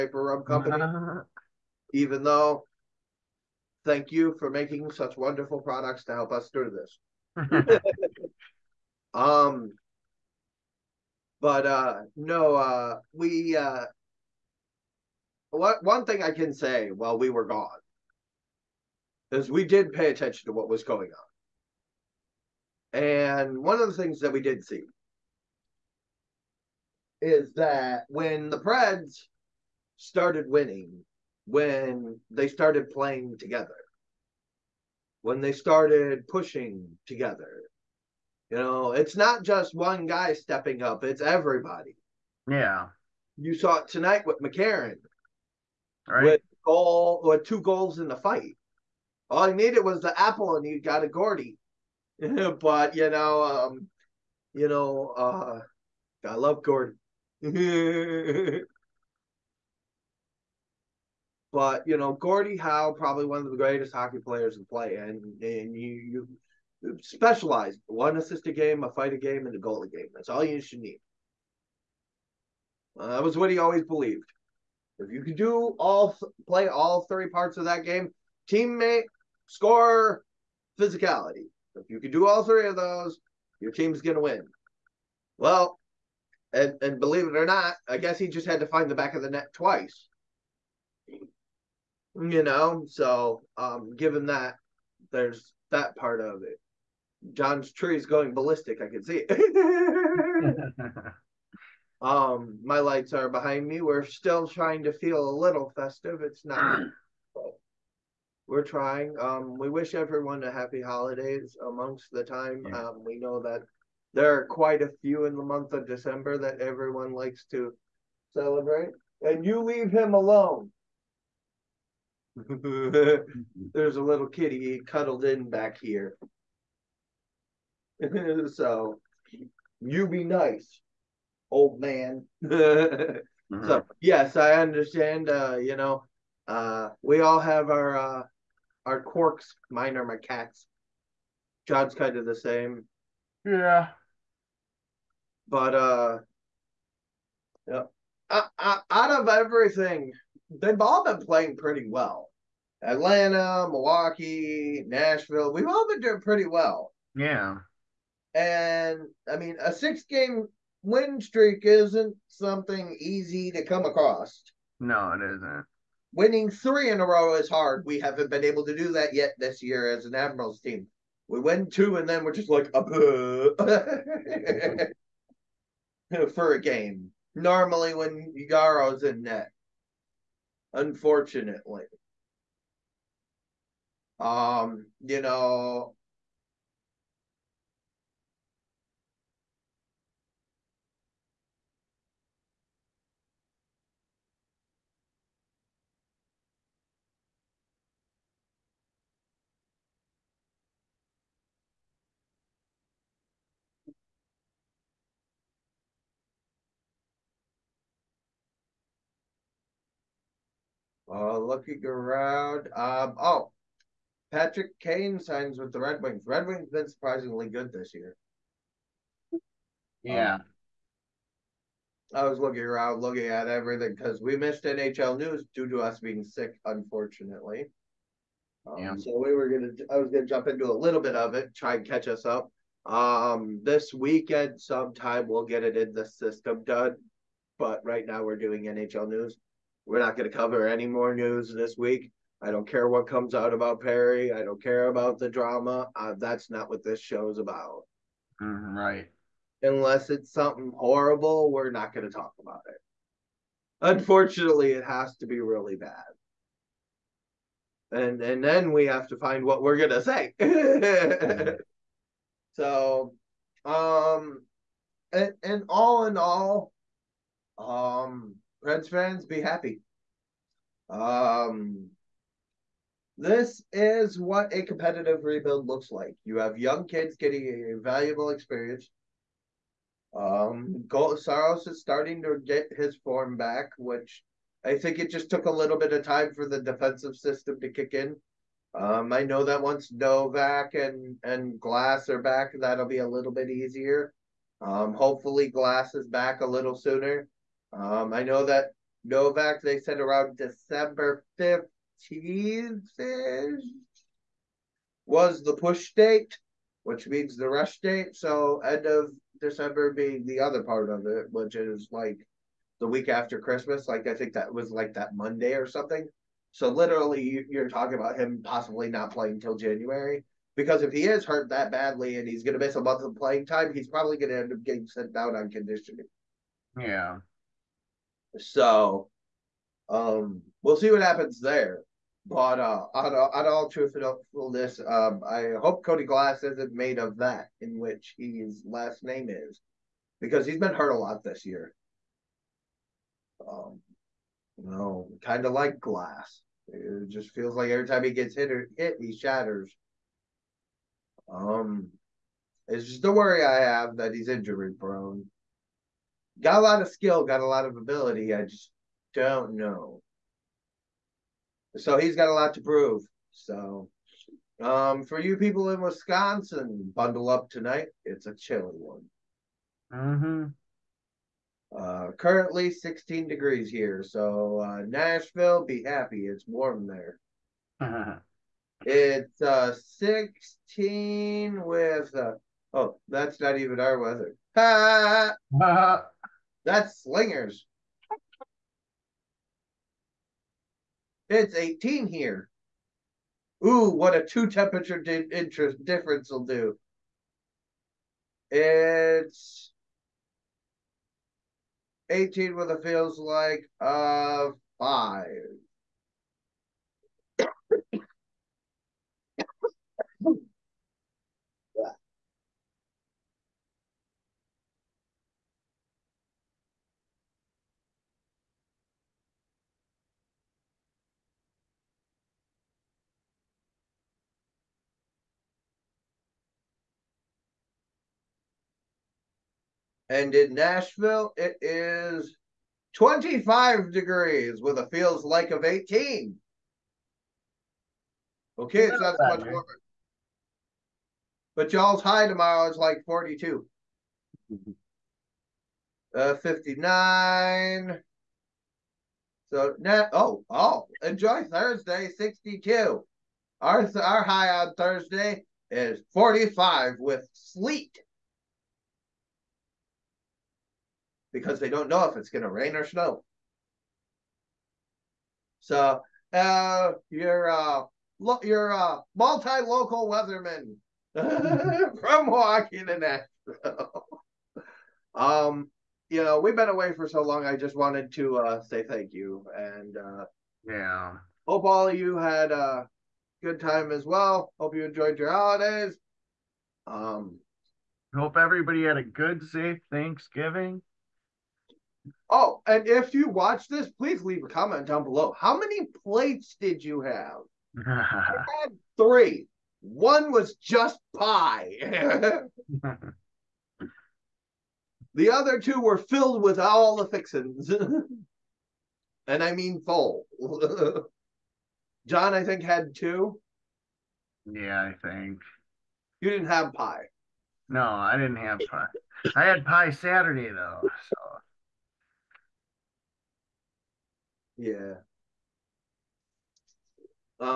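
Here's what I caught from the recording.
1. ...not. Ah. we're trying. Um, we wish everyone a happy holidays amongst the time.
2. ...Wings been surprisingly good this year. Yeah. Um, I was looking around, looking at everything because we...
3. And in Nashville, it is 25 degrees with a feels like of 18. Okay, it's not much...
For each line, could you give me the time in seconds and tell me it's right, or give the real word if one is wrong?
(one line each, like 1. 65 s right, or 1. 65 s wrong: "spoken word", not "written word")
1. 106 s right
2. 216 s right
3. 430 s right.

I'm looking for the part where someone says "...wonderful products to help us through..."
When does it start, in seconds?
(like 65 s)
5 s.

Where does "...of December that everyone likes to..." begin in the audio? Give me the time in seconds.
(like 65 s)
115 s.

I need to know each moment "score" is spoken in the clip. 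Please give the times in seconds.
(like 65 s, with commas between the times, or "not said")
79 s.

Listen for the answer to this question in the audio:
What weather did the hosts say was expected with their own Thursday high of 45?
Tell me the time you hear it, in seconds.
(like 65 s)
457 s.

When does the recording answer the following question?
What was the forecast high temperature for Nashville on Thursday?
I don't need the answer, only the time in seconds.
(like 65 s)
452 s.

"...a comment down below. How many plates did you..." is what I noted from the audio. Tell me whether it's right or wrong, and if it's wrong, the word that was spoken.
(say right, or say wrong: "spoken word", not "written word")
right.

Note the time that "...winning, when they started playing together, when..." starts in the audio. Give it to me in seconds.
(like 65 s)
30 s.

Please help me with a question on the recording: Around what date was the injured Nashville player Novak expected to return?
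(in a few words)
December 15th.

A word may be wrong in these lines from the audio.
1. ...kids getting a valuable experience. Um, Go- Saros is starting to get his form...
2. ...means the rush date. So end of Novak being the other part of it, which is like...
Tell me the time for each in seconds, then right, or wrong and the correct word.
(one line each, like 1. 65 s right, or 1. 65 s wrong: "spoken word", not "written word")
1. 276 s right
2. 307 s wrong: "December", not "Novak".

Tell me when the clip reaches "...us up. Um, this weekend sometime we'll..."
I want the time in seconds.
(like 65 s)
232 s.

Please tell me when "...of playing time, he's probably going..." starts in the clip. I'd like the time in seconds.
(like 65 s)
323 s.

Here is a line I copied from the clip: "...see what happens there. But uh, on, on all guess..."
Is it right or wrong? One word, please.
wrong.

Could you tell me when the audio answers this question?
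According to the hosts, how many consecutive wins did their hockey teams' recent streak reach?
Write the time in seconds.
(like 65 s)
159 s.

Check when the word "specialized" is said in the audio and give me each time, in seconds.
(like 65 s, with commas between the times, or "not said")
67 s.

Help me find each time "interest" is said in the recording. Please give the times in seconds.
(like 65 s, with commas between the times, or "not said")
395 s.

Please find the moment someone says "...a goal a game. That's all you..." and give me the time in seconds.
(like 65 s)
69 s.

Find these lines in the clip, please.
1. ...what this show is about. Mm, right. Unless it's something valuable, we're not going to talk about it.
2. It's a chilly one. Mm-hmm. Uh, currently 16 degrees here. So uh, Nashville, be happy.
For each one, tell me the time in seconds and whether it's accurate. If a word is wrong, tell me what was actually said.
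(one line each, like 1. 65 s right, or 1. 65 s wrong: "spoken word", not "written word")
1. 246 s wrong: "horrible", not "valuable"
2. 368 s right.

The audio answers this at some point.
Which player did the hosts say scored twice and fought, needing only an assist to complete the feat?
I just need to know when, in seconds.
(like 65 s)
44 s.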